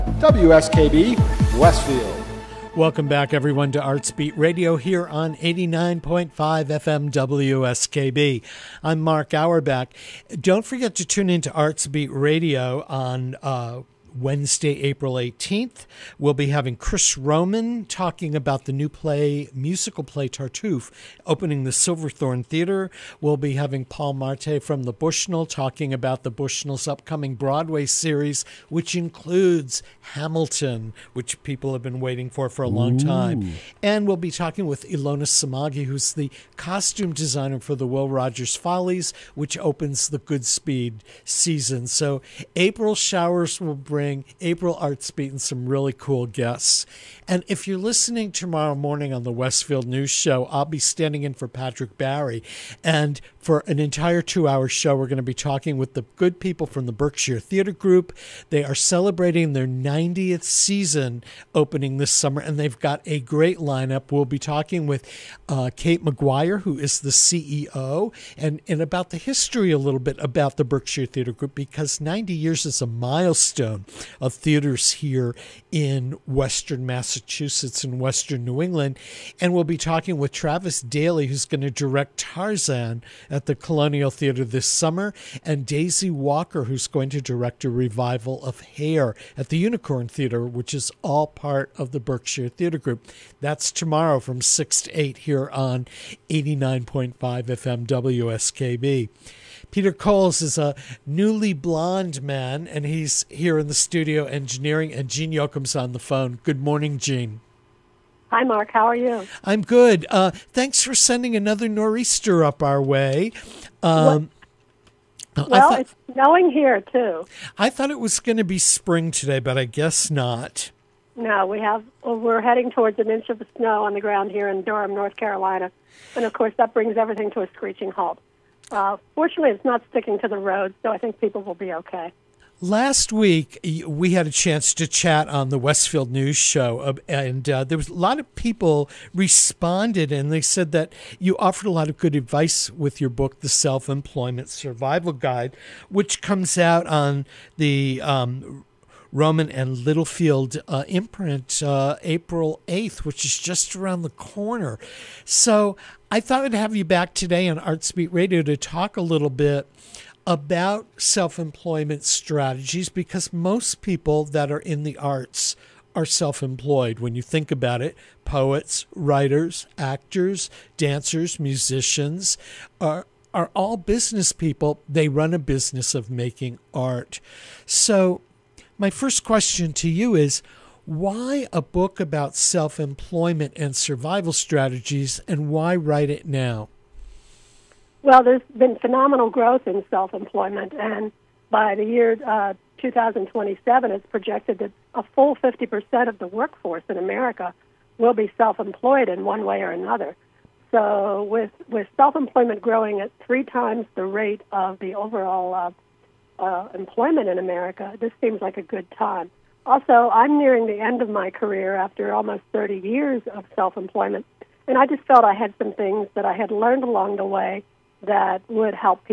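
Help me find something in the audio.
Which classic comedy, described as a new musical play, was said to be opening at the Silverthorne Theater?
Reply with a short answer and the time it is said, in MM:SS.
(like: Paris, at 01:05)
Tartuffe, at 00:20.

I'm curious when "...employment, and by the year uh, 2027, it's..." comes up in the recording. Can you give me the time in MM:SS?
03:10.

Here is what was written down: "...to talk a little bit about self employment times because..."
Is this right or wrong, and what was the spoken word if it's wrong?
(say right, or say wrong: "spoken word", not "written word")
wrong: "strategies", not "times".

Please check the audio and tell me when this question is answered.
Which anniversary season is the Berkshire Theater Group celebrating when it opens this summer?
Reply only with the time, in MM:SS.
00:59.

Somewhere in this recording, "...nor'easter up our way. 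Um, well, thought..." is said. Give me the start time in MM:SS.
01:51.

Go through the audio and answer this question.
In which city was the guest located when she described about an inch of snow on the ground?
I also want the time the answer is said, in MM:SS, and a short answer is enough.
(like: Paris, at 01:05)
Durham, North Carolina, at 02:04.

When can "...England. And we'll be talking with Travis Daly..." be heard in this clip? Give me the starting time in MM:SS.
01:18.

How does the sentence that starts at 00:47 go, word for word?
And if you're listening tomorrow morning on the Westfield News Show, I'll be standing in for Patrick Barry.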